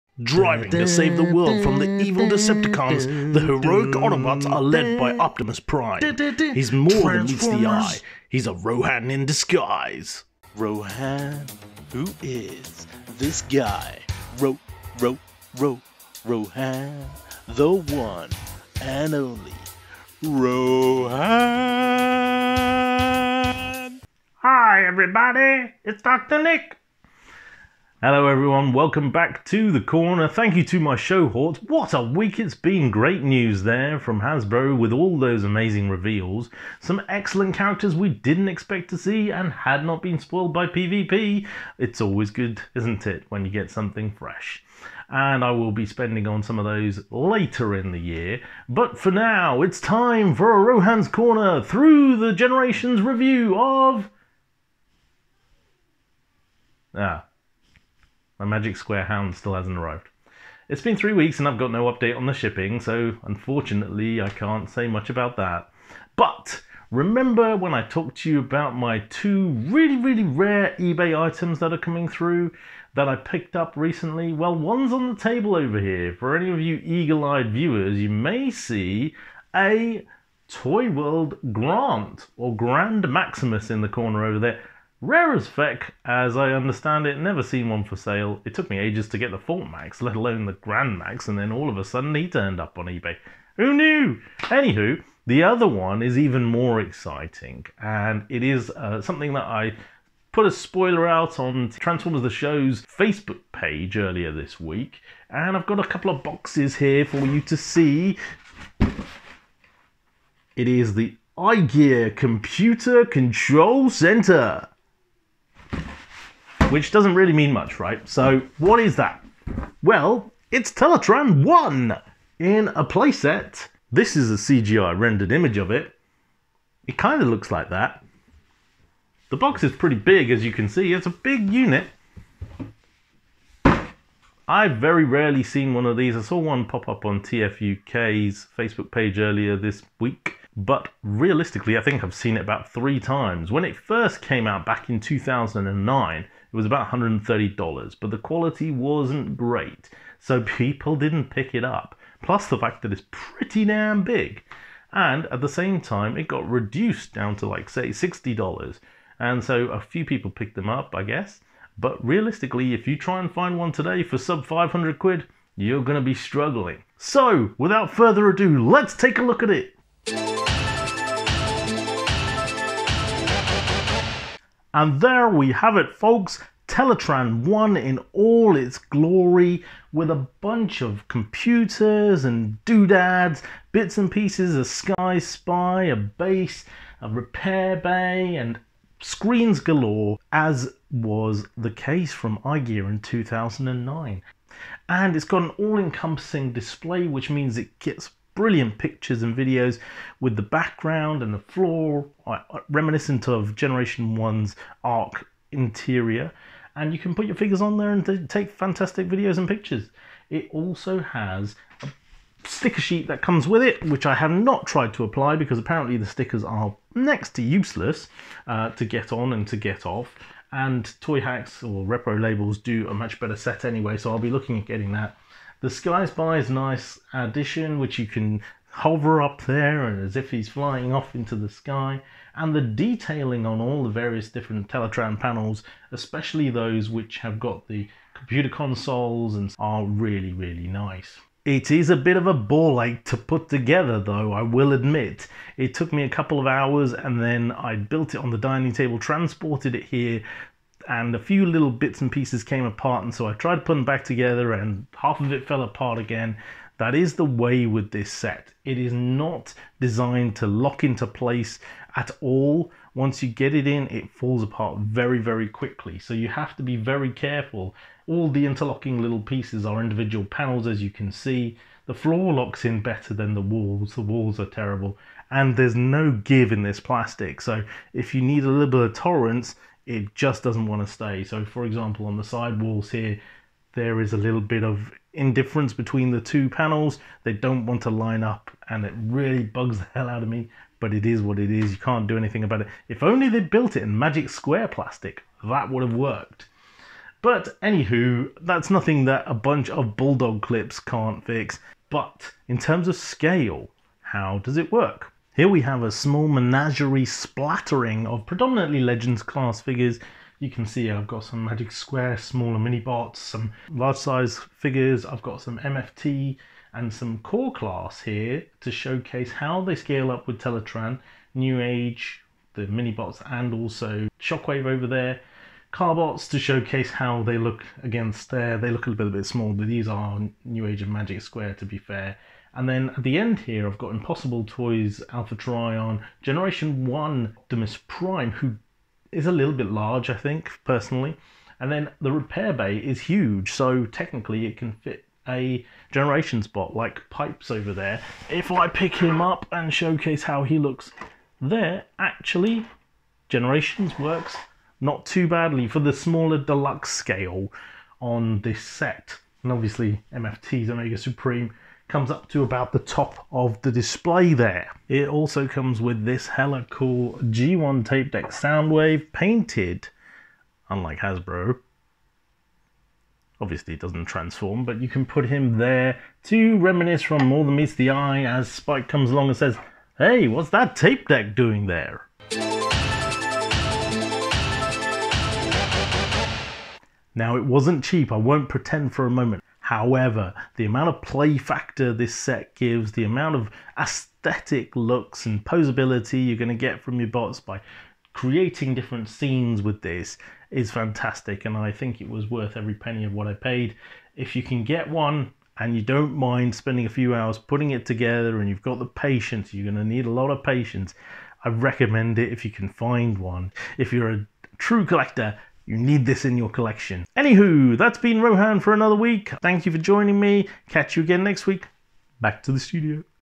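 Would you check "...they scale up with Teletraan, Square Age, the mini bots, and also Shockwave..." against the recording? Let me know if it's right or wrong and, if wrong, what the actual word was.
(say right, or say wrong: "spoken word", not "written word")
wrong: "New", not "Square".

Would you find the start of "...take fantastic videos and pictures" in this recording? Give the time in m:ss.
3:28.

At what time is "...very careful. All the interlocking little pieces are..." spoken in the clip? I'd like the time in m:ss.
4:26.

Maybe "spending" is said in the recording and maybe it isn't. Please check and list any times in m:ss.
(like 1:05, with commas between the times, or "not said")
0:45, 6:46.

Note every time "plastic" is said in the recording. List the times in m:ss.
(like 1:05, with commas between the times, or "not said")
4:36, 4:54.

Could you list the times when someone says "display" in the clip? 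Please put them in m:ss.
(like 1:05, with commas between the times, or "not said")
3:16, 6:03.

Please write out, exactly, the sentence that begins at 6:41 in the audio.
And I think it was worth every penny of what I paid.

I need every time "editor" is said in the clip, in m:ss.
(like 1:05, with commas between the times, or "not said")
not said.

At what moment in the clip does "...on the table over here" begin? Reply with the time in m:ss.
1:14.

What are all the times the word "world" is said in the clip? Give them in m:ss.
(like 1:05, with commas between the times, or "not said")
0:01, 1:20.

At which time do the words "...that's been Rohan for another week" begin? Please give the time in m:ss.
6:57.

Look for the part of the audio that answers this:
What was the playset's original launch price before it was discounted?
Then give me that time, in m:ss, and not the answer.
2:26.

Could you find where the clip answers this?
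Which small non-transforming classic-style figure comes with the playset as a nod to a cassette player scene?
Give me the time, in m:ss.
6:08.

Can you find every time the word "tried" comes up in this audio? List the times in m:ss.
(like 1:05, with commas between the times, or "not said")
3:34, 4:13.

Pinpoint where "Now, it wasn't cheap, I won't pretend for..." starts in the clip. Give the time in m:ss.
6:27.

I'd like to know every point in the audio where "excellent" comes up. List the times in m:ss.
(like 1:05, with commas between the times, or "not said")
0:37.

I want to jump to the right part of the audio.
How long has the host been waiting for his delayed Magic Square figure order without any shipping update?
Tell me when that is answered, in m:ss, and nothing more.
1:00.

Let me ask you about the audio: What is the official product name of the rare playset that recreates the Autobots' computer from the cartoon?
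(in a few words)
Computer Control Center.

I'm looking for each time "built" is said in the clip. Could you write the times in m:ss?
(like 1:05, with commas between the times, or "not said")
4:07, 4:53.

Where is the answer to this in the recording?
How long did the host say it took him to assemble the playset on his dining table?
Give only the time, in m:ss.
4:06.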